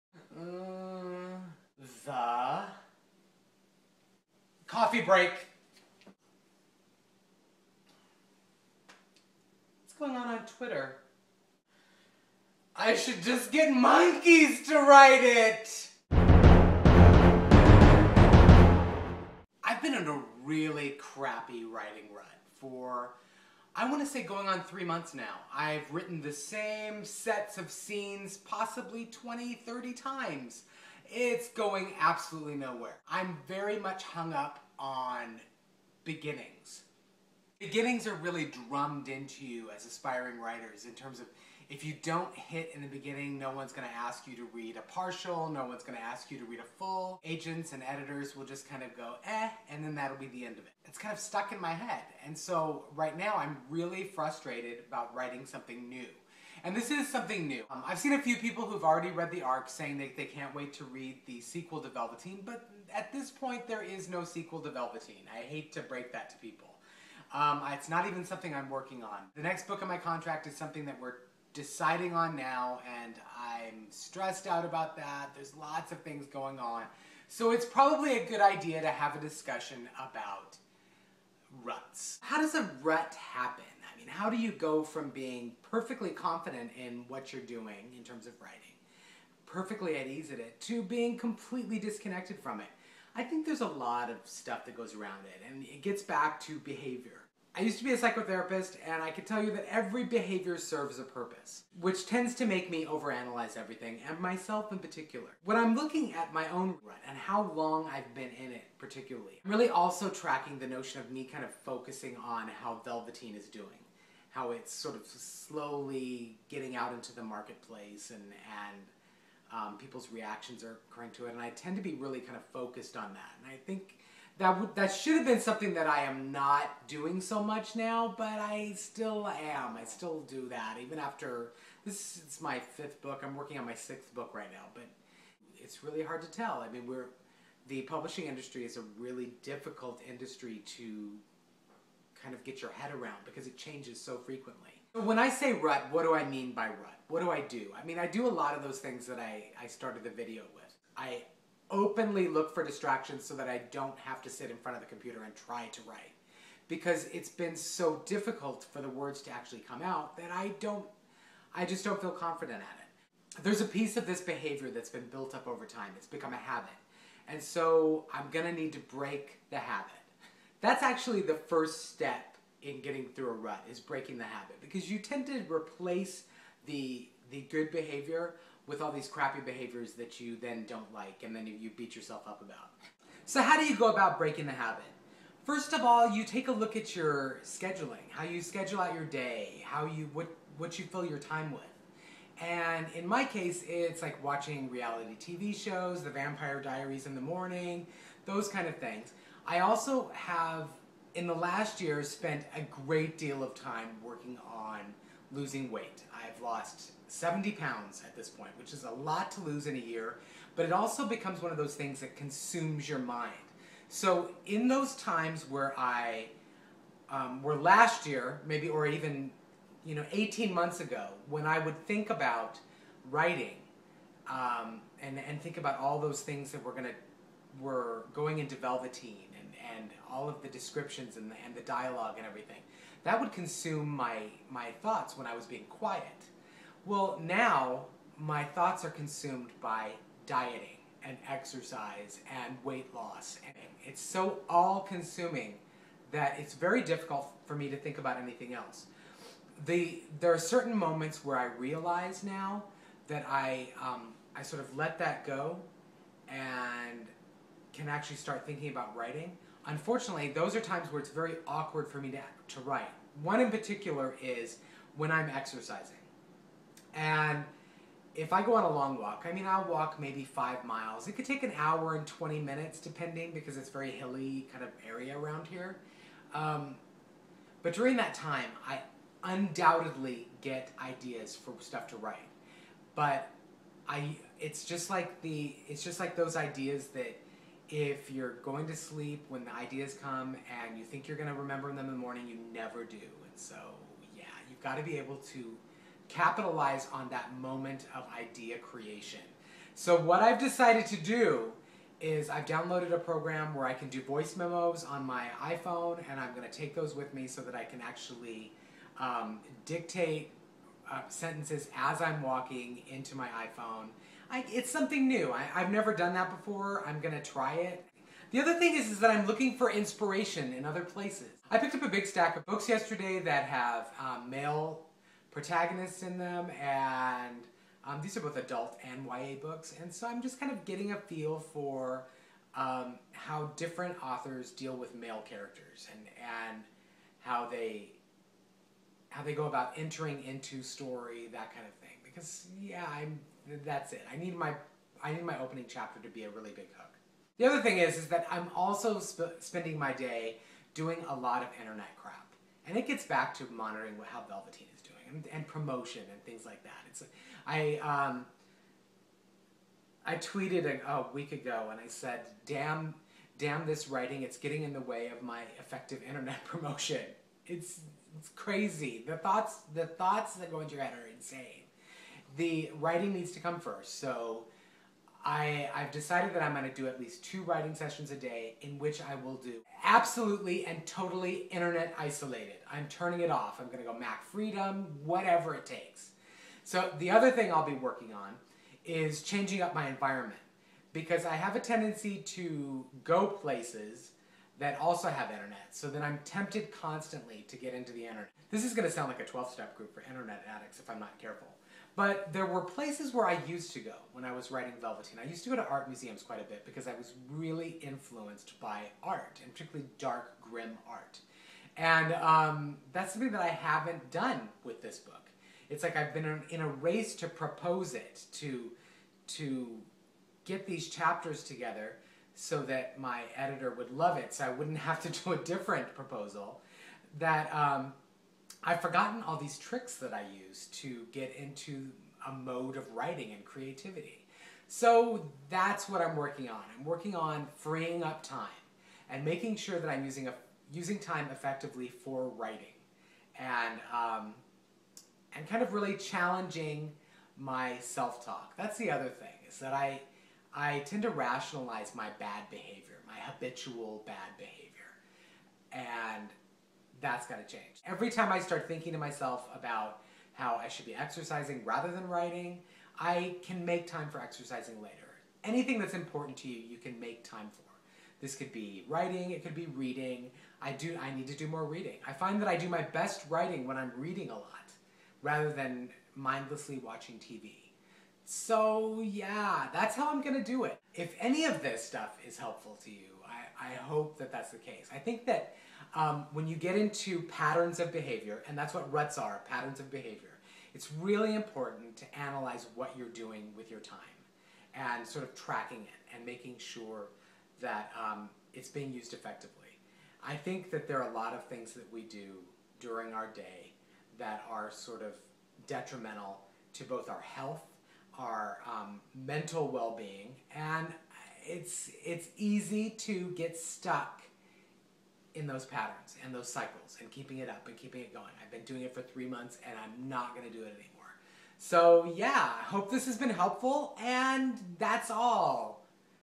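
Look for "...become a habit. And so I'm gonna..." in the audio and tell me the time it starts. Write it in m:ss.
2:46.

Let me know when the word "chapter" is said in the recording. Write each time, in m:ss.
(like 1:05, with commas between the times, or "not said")
5:45, 7:00.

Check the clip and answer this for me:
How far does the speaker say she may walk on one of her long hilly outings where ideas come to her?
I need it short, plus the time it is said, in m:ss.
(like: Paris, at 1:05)
5 miles, at 4:30.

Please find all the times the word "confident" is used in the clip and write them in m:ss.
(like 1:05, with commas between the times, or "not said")
1:26, 2:42.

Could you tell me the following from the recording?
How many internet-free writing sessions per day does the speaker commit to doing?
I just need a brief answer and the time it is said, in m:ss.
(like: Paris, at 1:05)
2, at 6:17.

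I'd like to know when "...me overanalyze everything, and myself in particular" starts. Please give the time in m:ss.
1:42.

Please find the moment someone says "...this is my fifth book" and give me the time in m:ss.
2:11.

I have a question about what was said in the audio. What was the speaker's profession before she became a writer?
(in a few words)
Psychotherapist.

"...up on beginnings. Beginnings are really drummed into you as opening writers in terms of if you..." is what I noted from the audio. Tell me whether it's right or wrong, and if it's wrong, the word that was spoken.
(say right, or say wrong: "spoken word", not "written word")
wrong: "aspiring", not "opening".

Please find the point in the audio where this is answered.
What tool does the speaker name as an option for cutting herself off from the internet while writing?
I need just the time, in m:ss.
6:23.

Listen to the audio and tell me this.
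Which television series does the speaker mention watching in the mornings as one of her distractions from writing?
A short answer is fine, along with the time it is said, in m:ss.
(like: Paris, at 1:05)
The Vampire Diaries, at 3:16.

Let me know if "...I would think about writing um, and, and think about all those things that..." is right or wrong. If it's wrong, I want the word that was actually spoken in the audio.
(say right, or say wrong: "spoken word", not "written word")
right.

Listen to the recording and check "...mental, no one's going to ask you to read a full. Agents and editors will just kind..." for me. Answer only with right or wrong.
wrong.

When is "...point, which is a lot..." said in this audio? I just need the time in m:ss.
3:28.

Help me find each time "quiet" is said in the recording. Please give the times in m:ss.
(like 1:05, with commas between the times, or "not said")
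3:55.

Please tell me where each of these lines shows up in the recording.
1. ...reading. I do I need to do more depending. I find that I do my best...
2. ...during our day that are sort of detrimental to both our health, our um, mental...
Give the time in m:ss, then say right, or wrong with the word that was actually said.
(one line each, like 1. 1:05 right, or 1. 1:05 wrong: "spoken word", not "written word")
1. 7:49 wrong: "reading", not "depending"
2. 8:22 right.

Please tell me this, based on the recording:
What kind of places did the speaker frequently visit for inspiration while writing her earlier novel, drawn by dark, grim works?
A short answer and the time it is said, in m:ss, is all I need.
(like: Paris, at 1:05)
Art museums, at 6:45.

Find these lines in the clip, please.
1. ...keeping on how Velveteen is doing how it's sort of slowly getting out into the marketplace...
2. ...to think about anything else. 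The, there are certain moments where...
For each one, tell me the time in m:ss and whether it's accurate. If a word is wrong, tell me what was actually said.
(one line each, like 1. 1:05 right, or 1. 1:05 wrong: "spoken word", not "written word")
1. 1:51 wrong: "focusing", not "keeping"
2. 4:07 right.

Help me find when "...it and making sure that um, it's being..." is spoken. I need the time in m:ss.
8:15.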